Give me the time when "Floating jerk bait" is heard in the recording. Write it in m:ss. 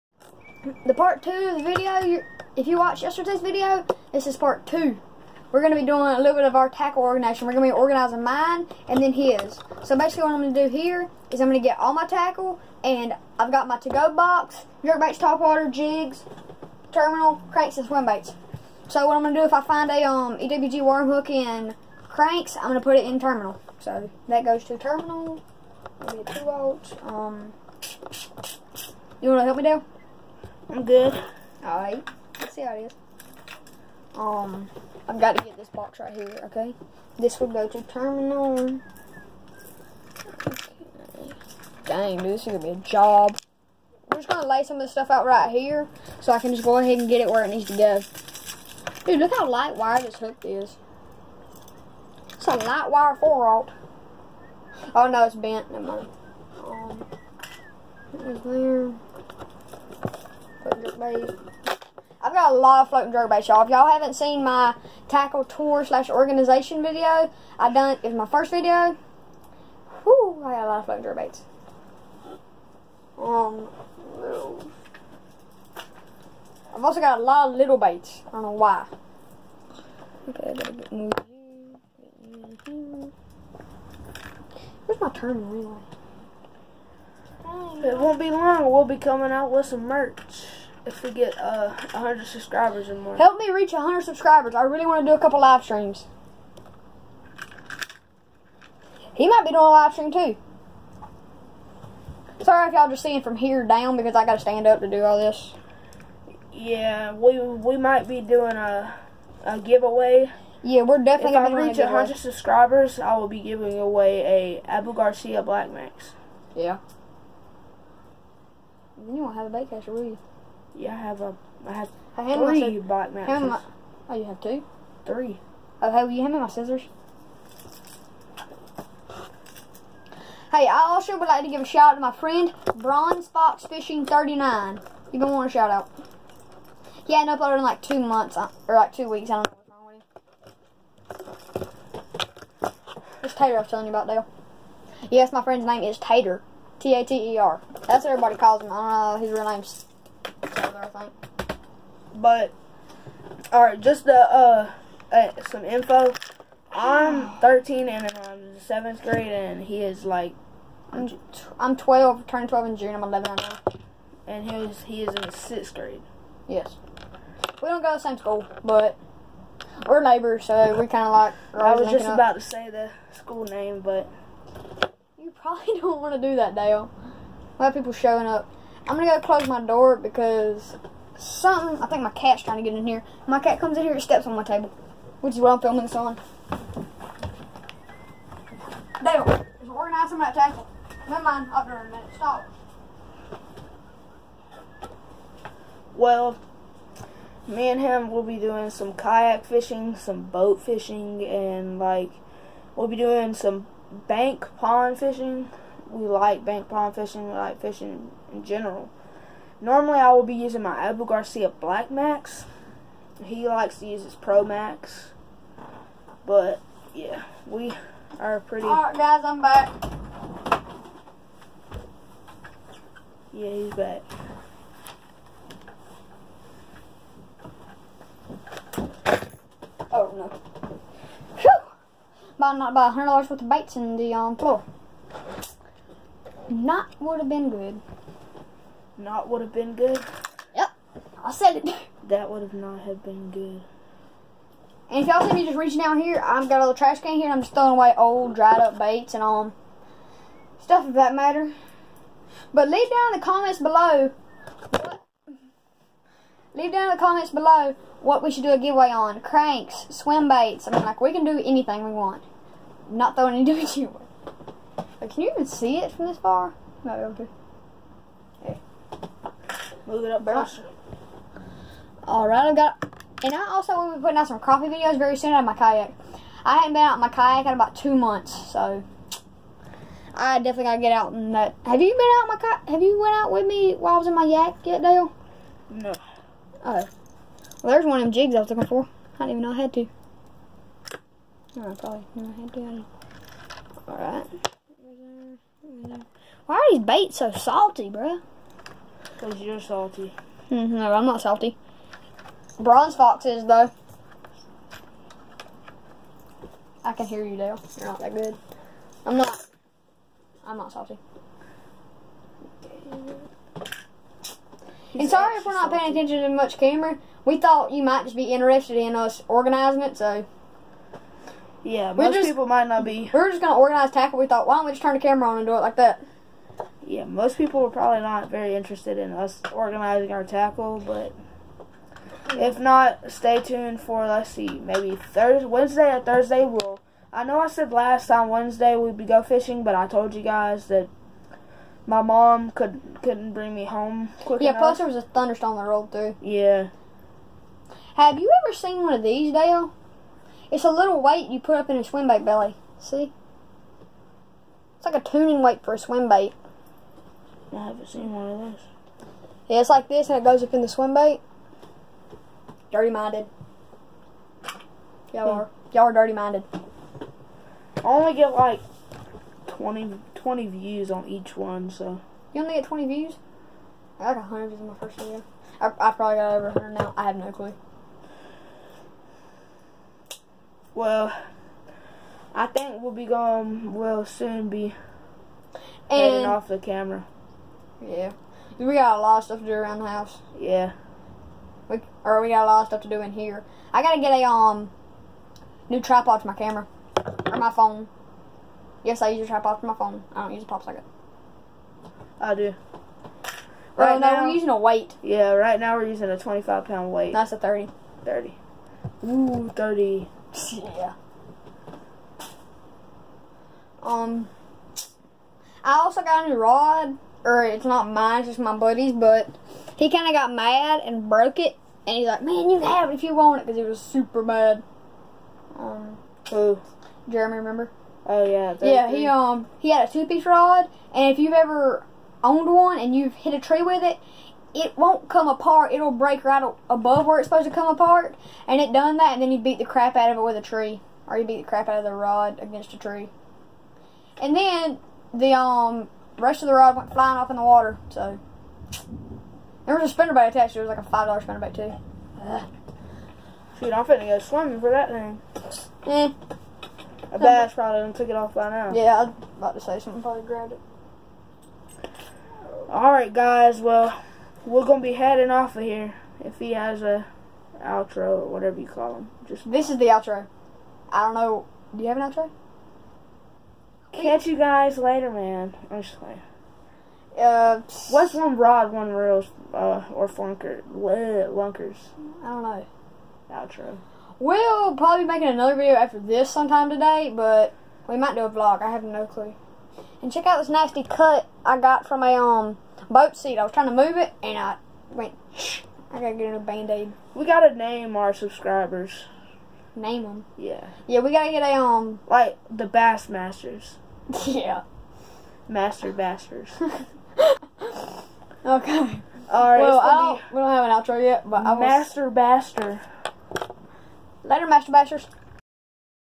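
1:00.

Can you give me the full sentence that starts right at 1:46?
Yeah, we we might be doing a a giveaway.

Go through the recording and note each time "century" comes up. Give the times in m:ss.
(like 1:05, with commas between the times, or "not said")
not said.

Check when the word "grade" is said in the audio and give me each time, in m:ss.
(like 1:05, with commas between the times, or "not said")
2:39, 2:45.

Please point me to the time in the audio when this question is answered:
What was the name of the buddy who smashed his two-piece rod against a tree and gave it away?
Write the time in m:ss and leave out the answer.
7:07.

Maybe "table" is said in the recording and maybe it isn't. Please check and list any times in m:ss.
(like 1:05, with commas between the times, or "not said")
3:04, 3:10.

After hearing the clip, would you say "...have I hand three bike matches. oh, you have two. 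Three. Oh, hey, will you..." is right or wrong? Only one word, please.
right.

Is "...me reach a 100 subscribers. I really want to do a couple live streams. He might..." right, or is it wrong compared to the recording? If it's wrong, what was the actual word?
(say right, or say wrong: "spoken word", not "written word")
right.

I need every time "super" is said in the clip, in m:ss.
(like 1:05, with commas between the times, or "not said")
7:03.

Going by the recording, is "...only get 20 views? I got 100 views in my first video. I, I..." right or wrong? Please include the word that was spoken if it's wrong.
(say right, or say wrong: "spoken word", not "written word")
right.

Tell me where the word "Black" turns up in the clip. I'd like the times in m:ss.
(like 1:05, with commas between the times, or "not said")
1:55, 3:31.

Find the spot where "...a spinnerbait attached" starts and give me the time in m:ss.
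7:29.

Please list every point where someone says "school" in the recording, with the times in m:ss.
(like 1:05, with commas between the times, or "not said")
2:48, 2:53.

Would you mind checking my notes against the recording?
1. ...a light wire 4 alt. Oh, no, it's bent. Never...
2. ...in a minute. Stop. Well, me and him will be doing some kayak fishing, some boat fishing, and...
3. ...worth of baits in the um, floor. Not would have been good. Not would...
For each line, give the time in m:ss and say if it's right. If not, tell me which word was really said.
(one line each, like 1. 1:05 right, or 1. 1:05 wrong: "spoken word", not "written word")
1. 0:52 right
2. 3:11 right
3. 3:53 right.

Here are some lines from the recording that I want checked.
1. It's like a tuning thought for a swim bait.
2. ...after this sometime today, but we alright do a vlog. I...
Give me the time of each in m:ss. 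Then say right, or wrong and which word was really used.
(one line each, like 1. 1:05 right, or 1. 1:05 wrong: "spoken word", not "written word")
1. 5:54 wrong: "weight", not "thought"
2. 8:05 wrong: "might", not "alright".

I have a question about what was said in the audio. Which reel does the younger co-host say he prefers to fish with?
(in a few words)
Pro Max.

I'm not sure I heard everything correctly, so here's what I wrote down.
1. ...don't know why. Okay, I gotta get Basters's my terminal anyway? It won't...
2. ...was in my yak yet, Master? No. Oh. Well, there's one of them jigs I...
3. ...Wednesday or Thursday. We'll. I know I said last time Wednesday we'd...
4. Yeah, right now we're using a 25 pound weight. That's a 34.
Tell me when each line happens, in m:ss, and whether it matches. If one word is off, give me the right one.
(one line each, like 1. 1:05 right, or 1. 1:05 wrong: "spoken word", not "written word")
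1. 1:18 wrong: "Where", not "Basters"
2. 4:43 wrong: "Dale", not "Master"
3. 5:35 right
4. 6:45 wrong: "30", not "34".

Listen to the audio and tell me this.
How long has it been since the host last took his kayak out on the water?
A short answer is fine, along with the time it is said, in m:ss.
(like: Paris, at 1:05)
about two months, at 4:37.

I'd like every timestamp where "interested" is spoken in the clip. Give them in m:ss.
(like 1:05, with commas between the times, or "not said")
5:18, 5:28.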